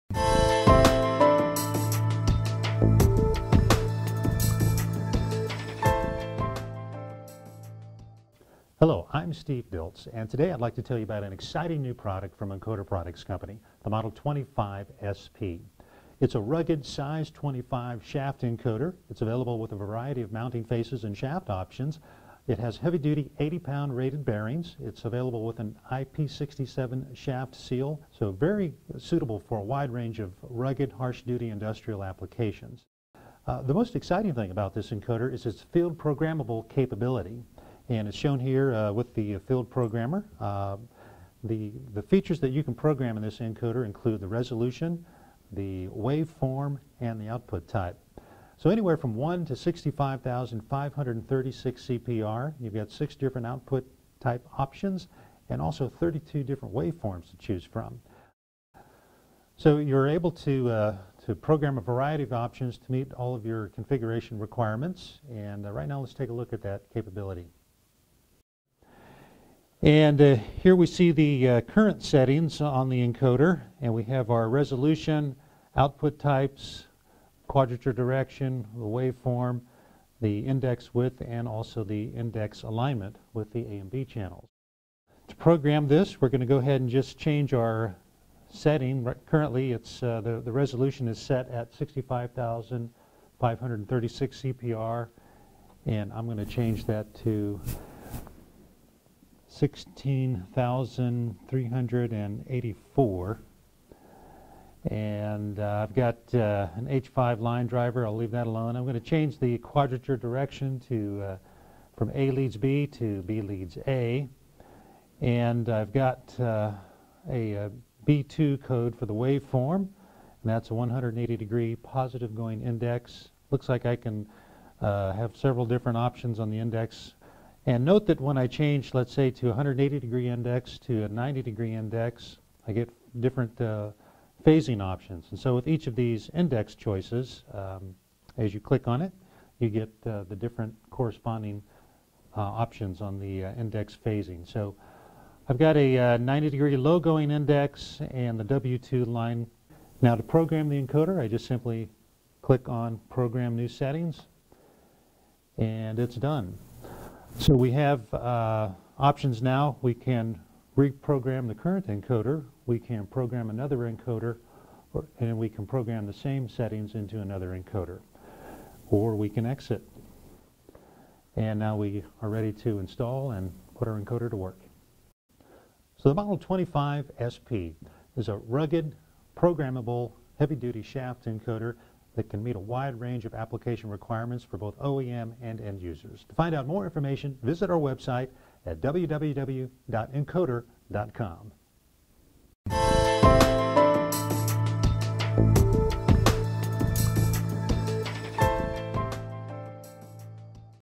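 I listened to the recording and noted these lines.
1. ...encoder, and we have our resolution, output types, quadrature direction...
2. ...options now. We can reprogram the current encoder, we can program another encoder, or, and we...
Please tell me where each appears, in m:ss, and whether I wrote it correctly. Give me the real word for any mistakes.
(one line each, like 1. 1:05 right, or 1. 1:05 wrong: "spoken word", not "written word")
1. 1:12 right
2. 2:38 right.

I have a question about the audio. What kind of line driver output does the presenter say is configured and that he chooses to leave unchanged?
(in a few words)
H5 line driver.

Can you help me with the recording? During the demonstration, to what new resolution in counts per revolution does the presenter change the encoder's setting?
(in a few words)
16,384.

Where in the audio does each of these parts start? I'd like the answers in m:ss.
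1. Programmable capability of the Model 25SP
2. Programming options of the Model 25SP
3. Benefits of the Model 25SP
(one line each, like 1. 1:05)
1. 0:39
2. 1:07
3. 2:59.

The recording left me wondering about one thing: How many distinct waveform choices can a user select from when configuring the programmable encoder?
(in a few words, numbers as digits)
32.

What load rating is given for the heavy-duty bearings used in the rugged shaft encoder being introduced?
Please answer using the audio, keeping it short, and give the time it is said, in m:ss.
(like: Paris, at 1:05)
80 pounds, at 0:23.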